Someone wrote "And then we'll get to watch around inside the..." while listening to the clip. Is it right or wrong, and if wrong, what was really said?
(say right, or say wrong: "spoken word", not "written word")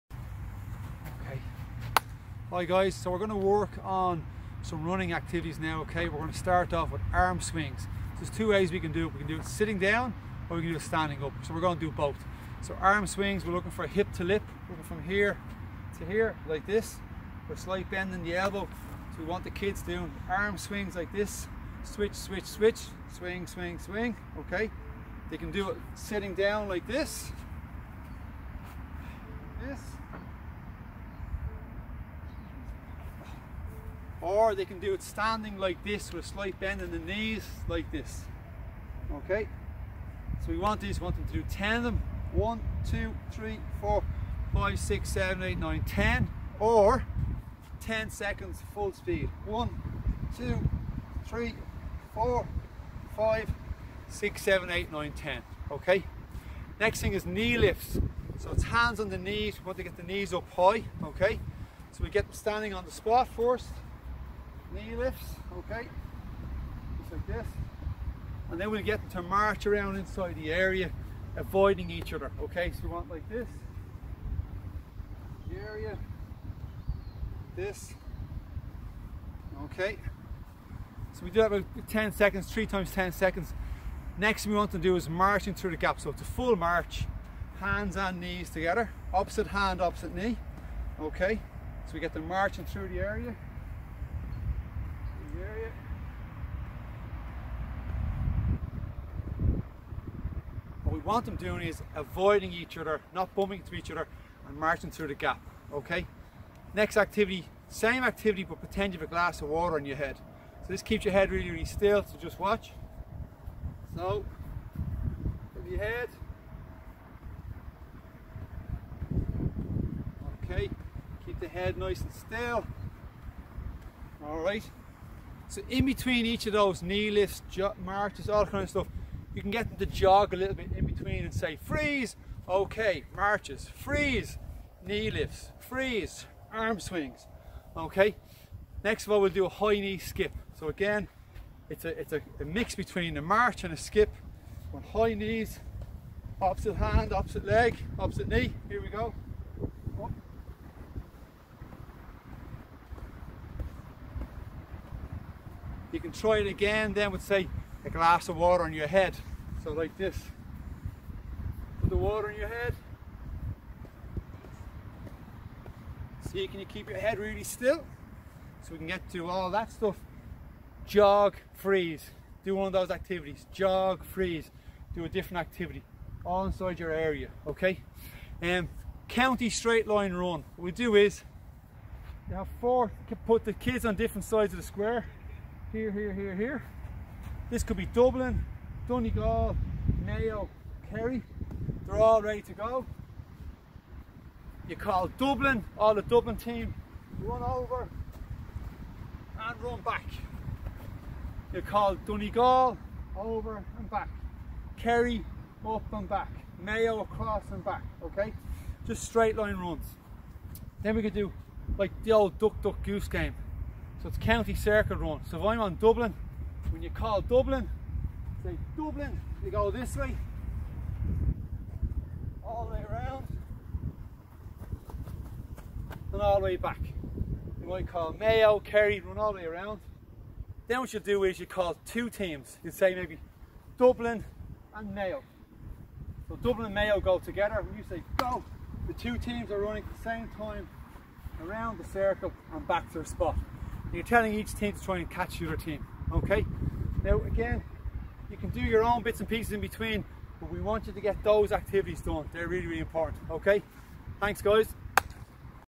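wrong: "march", not "watch".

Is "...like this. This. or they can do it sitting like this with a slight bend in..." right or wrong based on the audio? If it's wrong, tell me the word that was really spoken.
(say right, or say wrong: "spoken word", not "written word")
wrong: "standing", not "sitting".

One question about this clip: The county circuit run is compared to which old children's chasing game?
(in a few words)
duck duck goose.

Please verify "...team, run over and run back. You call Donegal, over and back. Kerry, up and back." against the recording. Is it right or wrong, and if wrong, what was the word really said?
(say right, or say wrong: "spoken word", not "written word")
right.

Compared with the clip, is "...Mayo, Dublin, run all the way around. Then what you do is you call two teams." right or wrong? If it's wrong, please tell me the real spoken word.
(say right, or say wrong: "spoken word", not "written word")
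wrong: "Kerry", not "Dublin".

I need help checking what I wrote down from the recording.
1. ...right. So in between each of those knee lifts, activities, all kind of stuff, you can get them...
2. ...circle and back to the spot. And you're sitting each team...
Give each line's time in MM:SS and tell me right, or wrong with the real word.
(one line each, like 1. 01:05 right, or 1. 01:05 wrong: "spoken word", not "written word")
1. 02:04 wrong: "marches", not "activities"
2. 04:01 wrong: "telling", not "sitting".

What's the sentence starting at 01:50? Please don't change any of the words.
So this keeps your head really, really still, so just watch.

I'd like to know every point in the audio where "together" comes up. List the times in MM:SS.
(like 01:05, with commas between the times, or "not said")
01:28, 03:57.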